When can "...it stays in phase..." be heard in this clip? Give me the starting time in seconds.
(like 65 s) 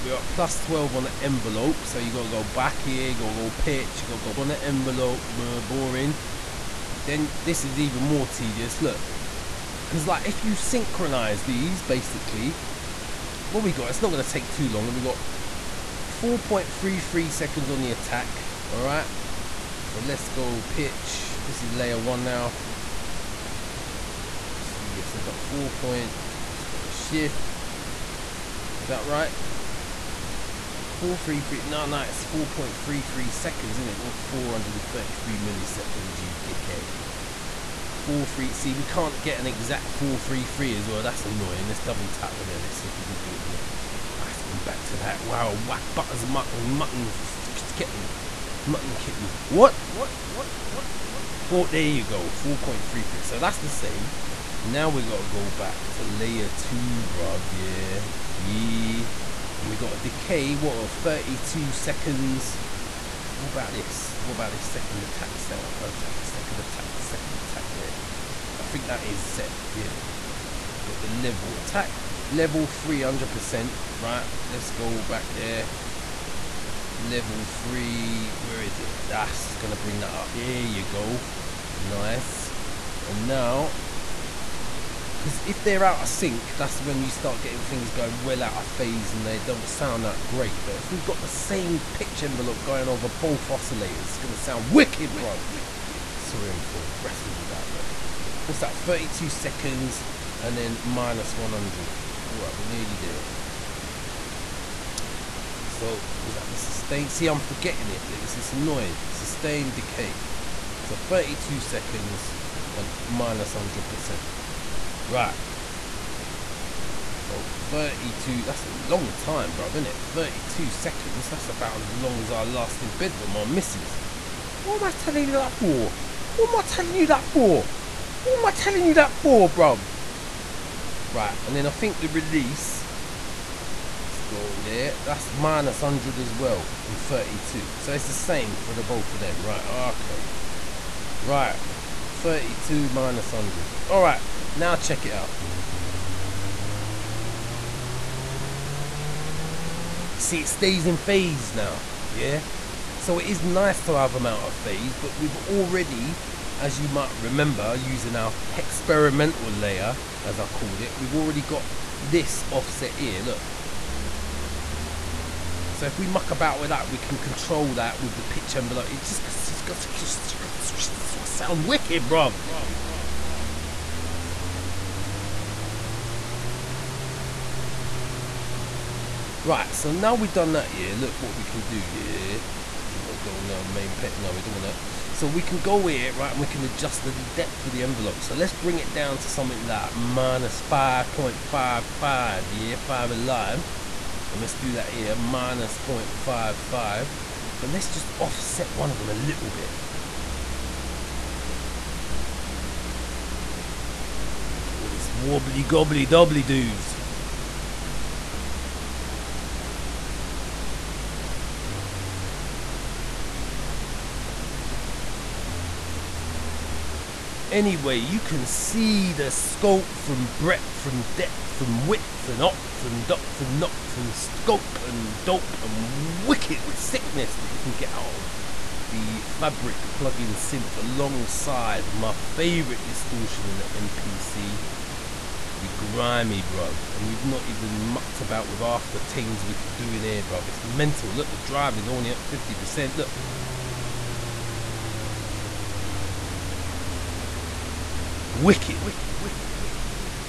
150 s.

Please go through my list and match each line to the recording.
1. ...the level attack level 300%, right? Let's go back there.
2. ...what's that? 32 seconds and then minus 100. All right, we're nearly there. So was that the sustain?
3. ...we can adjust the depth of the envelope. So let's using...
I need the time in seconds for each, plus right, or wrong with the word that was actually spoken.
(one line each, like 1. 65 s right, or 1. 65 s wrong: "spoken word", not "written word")
1. 71 s right
2. 98 s right
3. 186 s wrong: "bring", not "using".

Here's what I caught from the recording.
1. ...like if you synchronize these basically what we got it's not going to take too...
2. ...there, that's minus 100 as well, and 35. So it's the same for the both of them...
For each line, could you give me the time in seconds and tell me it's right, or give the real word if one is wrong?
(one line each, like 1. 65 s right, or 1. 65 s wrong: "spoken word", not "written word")
1. 10 s right
2. 134 s wrong: "32", not "35".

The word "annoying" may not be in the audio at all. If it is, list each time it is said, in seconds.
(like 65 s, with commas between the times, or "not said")
41 s, 108 s.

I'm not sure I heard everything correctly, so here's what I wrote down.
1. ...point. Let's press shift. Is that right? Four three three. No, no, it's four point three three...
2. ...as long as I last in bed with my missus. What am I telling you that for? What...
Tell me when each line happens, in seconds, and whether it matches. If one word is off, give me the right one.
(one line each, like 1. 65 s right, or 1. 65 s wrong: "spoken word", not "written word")
1. 25 s right
2. 121 s right.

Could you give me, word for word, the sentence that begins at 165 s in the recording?
So if we muck about with that, we can control that with the pitch envelope.